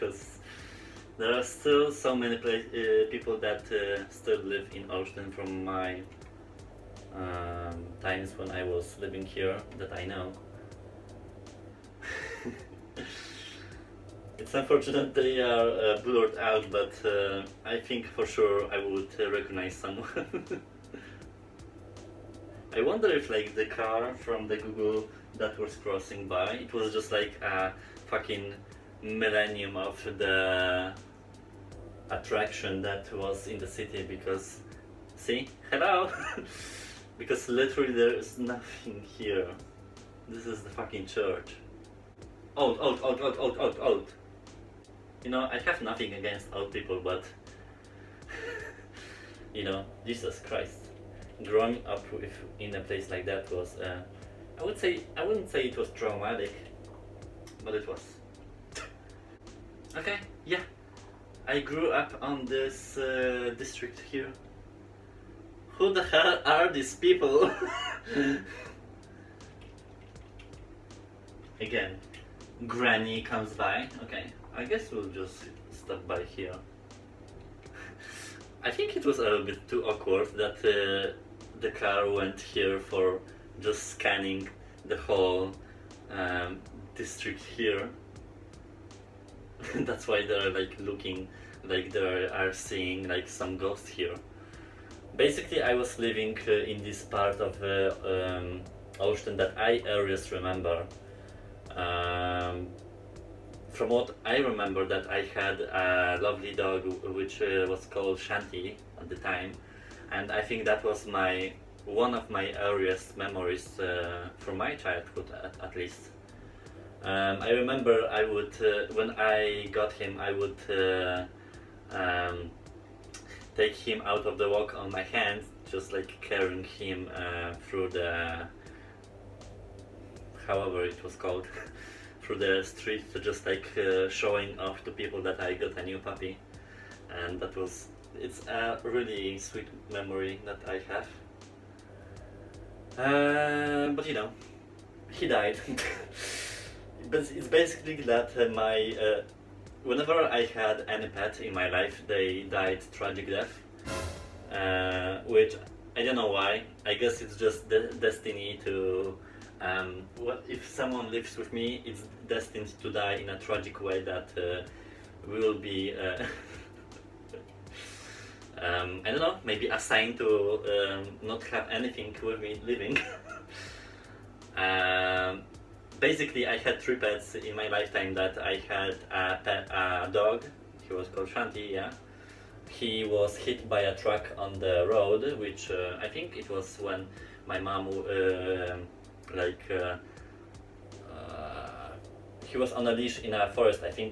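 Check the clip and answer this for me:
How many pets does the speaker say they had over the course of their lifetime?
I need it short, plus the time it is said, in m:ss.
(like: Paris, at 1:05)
3, at 2:56.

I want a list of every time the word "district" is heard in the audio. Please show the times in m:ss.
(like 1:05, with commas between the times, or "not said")
1:03, 1:26.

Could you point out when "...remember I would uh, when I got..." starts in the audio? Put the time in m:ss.
1:57.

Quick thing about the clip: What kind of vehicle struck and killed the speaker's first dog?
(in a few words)
A truck.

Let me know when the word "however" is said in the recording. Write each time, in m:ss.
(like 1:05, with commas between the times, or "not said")
2:10.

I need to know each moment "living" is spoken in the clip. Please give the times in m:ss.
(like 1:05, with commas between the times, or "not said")
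0:08, 1:35, 2:52.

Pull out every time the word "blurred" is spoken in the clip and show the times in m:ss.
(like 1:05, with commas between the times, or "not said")
0:16.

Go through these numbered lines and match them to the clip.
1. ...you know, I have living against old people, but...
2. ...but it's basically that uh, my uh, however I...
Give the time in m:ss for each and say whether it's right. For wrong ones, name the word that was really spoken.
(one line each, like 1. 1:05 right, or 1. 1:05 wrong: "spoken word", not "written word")
1. 0:45 wrong: "nothing", not "living"
2. 2:27 wrong: "whenever", not "however".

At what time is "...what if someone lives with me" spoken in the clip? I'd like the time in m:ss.
2:40.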